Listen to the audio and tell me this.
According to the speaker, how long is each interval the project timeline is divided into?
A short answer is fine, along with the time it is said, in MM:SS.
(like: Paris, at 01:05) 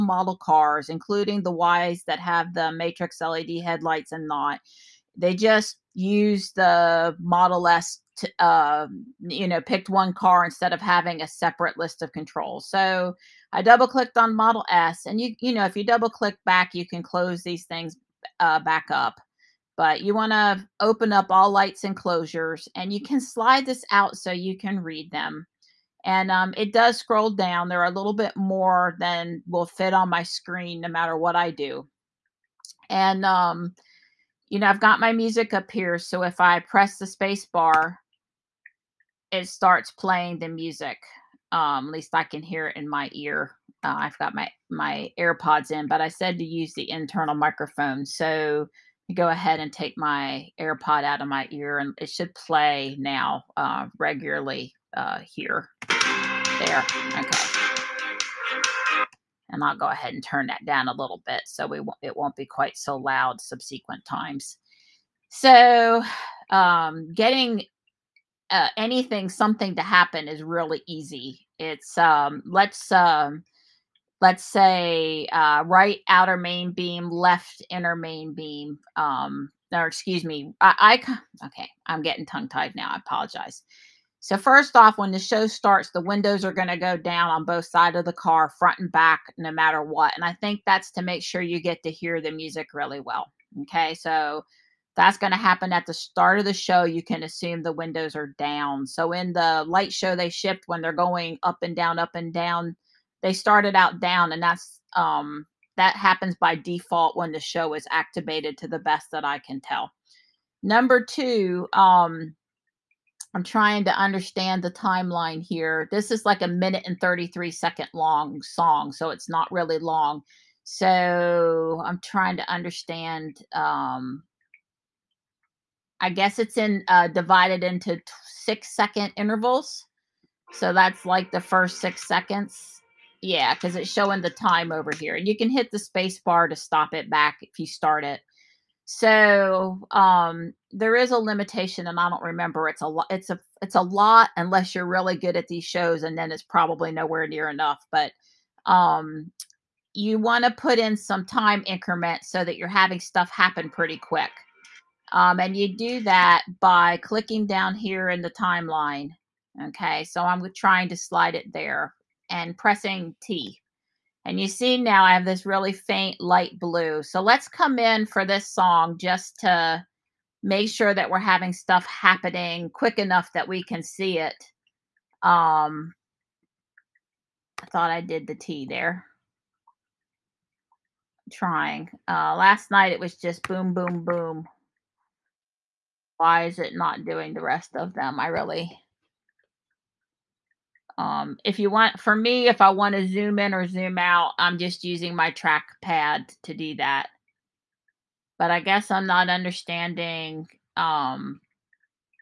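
6 seconds, at 02:08.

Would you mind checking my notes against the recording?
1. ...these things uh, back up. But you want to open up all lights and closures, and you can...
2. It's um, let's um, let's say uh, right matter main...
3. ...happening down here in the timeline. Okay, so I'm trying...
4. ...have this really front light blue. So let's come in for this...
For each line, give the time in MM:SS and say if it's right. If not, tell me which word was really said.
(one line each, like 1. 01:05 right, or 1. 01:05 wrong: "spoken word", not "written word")
1. 00:17 right
2. 01:11 wrong: "outer", not "matter"
3. 02:36 wrong: "clicking", not "happening"
4. 02:45 wrong: "faint", not "front".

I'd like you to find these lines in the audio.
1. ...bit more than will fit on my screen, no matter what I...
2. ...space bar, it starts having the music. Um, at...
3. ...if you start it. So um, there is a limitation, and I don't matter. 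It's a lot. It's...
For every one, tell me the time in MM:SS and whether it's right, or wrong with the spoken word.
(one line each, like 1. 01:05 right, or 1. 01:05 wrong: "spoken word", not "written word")
1. 00:28 right
2. 00:37 wrong: "playing", not "having"
3. 02:17 wrong: "remember", not "matter".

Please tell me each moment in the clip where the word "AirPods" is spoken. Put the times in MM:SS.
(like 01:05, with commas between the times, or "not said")
00:45, 00:50.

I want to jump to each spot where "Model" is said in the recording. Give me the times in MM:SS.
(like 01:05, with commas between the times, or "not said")
00:07, 00:14.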